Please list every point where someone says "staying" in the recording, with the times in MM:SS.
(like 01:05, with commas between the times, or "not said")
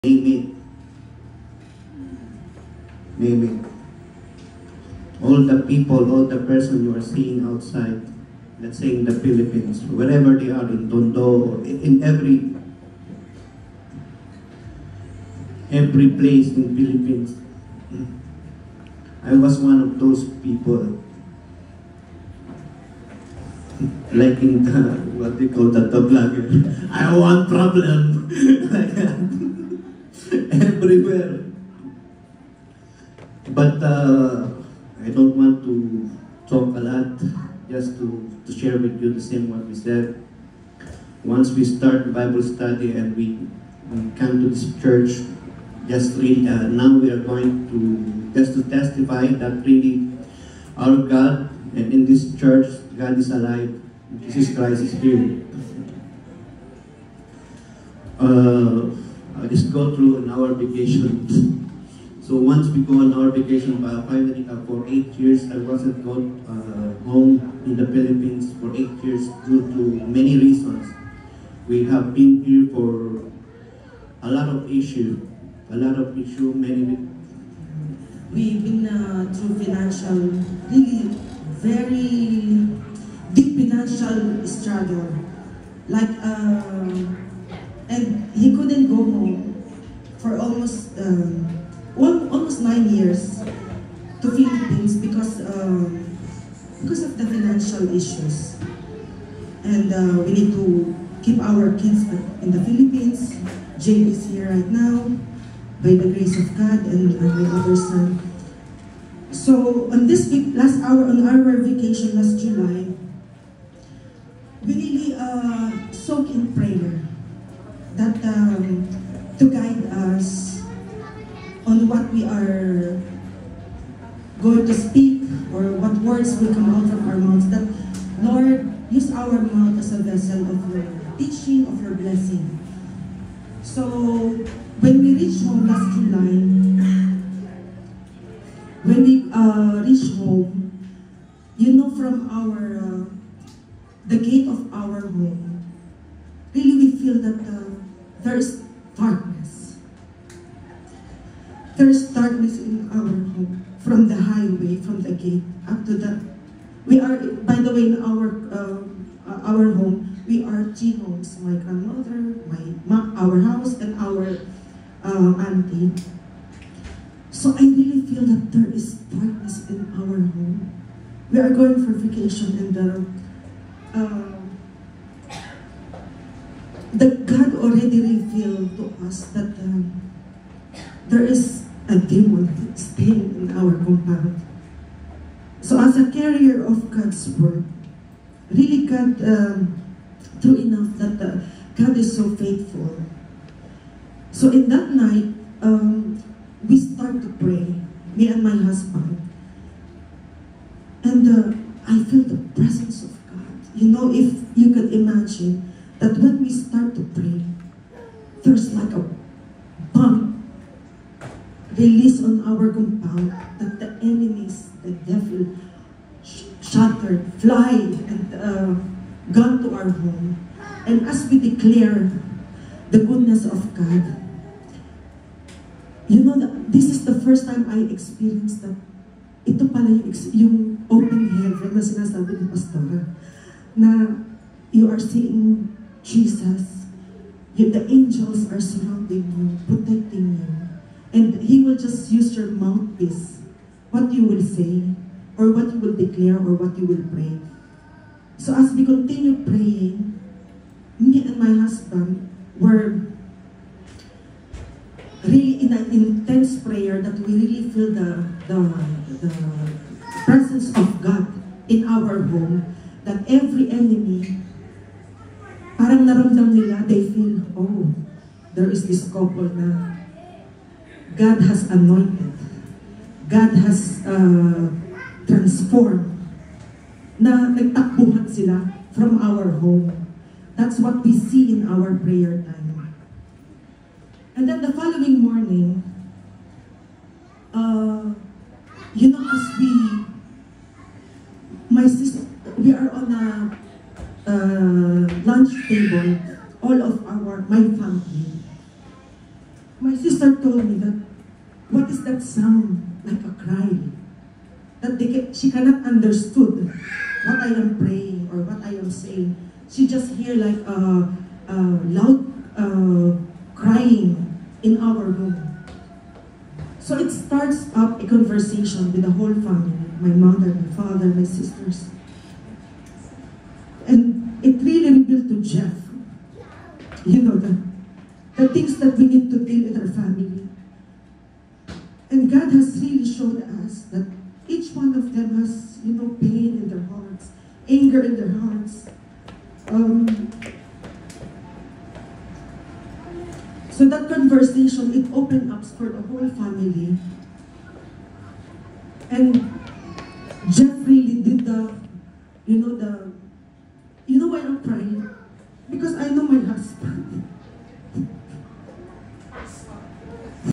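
03:02.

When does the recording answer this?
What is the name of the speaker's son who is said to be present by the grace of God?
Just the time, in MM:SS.
01:43.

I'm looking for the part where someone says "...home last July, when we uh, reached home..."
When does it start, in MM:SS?
02:15.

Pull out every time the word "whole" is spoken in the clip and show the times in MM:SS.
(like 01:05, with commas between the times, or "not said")
05:19, 05:46.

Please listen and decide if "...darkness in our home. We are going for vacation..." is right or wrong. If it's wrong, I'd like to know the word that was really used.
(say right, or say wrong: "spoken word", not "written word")
right.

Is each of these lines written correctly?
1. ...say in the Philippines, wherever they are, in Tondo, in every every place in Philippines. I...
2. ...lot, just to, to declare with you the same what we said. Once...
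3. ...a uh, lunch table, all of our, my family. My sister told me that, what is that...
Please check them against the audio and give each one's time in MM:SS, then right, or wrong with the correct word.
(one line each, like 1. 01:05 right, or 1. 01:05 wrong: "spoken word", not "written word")
1. 00:08 right
2. 00:36 wrong: "share", not "declare"
3. 04:53 right.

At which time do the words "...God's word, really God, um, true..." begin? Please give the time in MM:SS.
03:06.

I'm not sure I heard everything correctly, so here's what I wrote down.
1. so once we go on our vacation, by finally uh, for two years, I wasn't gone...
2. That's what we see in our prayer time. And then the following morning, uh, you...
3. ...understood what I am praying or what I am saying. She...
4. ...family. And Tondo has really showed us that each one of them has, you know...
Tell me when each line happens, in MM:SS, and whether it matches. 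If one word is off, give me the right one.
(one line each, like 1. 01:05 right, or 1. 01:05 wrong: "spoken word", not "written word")
1. 01:02 wrong: "eight", not "two"
2. 04:40 right
3. 05:05 right
4. 05:29 wrong: "God", not "Tondo".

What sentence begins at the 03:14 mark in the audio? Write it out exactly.
So in that night, um, we start to pray, me and my husband.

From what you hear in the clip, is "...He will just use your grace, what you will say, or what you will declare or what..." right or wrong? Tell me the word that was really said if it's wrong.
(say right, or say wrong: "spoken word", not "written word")
wrong: "mouthpiece", not "grace".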